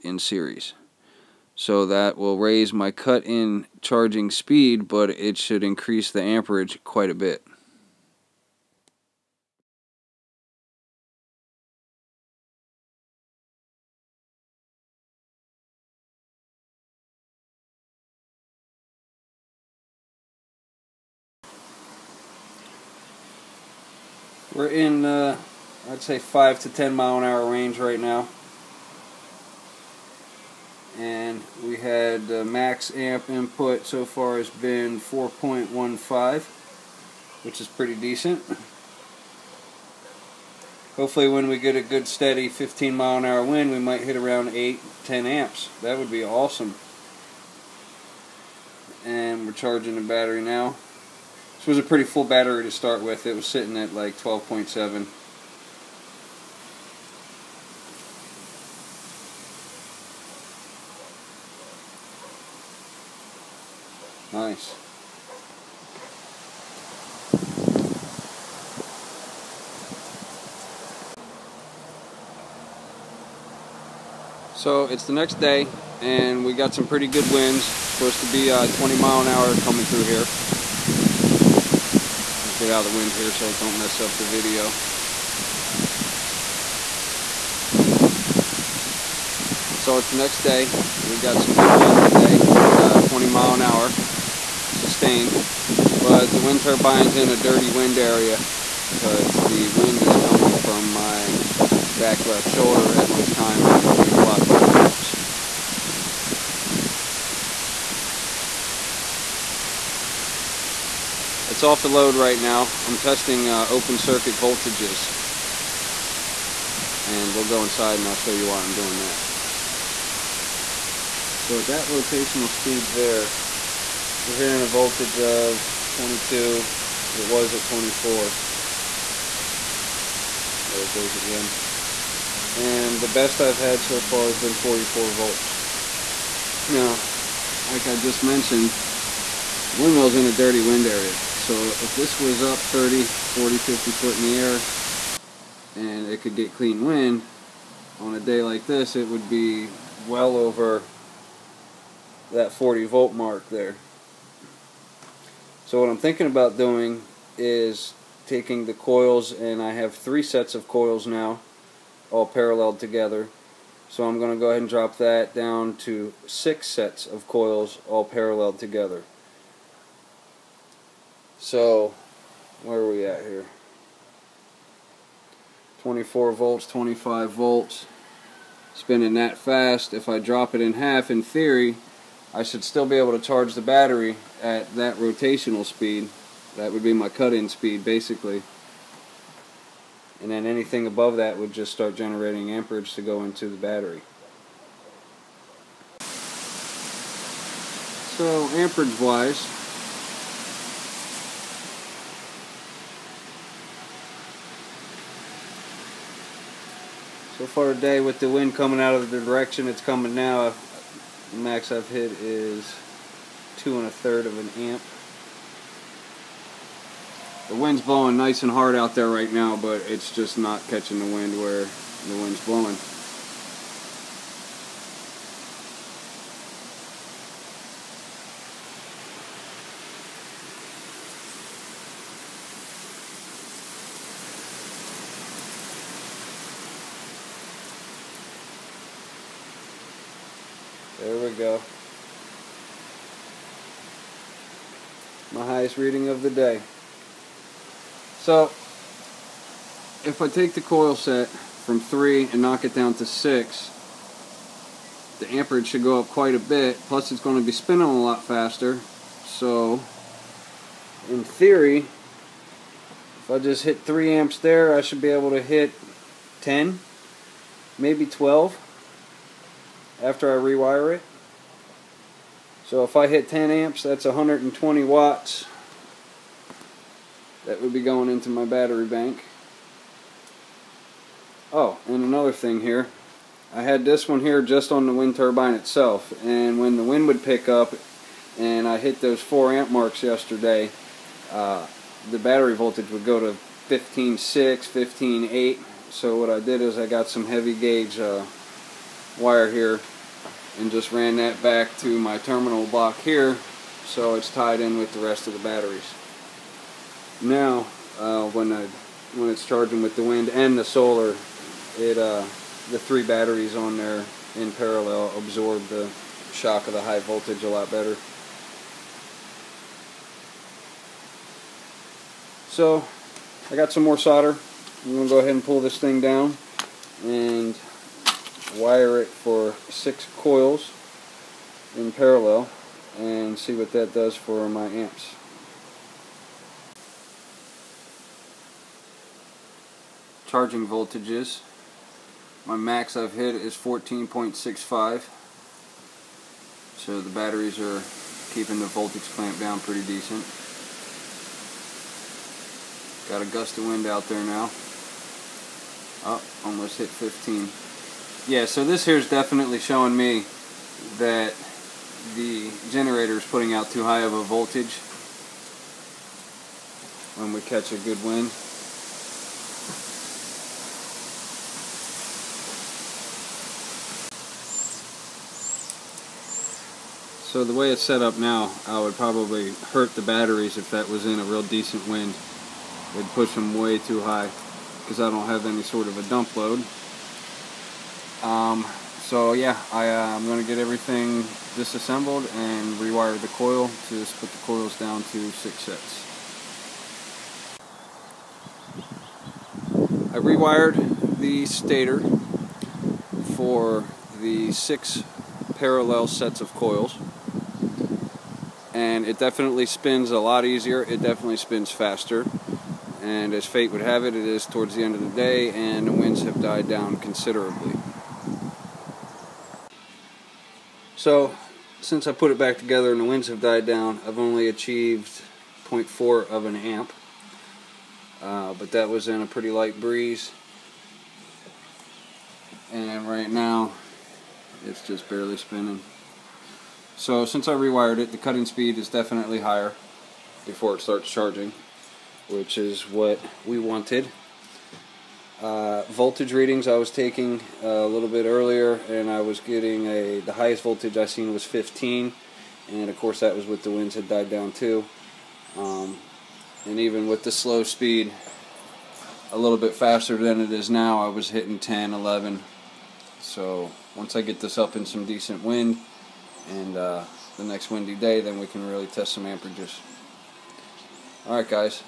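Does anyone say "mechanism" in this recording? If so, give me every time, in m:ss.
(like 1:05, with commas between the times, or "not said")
not said.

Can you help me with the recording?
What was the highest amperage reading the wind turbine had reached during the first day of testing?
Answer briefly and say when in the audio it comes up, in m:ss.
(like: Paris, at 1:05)
4.15, at 0:35.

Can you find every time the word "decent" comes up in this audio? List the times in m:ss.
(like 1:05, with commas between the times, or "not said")
0:37, 5:49, 6:21, 7:45.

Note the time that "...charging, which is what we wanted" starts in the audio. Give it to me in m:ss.
7:21.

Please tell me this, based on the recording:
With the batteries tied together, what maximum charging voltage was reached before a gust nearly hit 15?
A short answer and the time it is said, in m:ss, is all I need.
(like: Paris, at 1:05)
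14.65, at 5:43.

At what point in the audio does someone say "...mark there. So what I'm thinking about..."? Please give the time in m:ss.
2:33.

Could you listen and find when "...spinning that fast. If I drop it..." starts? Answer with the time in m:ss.
2:58.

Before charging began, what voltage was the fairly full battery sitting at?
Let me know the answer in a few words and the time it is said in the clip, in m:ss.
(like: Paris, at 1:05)
12.7, at 0:54.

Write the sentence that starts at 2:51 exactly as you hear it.
So where are we at here?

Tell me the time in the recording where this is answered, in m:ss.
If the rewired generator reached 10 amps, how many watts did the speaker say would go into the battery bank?
4:34.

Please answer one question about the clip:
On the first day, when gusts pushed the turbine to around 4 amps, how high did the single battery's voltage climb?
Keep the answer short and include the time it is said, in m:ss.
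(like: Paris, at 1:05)
15.6 to 15.8, at 4:53.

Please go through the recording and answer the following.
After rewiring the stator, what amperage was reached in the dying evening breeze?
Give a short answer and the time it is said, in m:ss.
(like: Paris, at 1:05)
0.4 amp, at 7:05.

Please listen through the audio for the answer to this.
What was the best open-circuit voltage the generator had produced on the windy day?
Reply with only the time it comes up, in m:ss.
2:14.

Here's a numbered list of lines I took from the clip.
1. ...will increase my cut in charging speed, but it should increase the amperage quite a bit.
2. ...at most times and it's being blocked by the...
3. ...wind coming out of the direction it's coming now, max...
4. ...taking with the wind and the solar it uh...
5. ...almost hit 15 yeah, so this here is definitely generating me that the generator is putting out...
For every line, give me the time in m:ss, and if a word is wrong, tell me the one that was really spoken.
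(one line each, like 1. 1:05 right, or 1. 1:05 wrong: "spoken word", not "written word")
1. 0:02 wrong: "raise", not "increase"
2. 1:42 right
3. 3:28 right
4. 5:09 wrong: "charging", not "taking"
5. 5:56 wrong: "showing", not "generating".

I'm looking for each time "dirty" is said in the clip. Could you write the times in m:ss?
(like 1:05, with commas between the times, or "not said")
1:37, 2:20.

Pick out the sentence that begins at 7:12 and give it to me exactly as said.
And right now, it's just barely spinning.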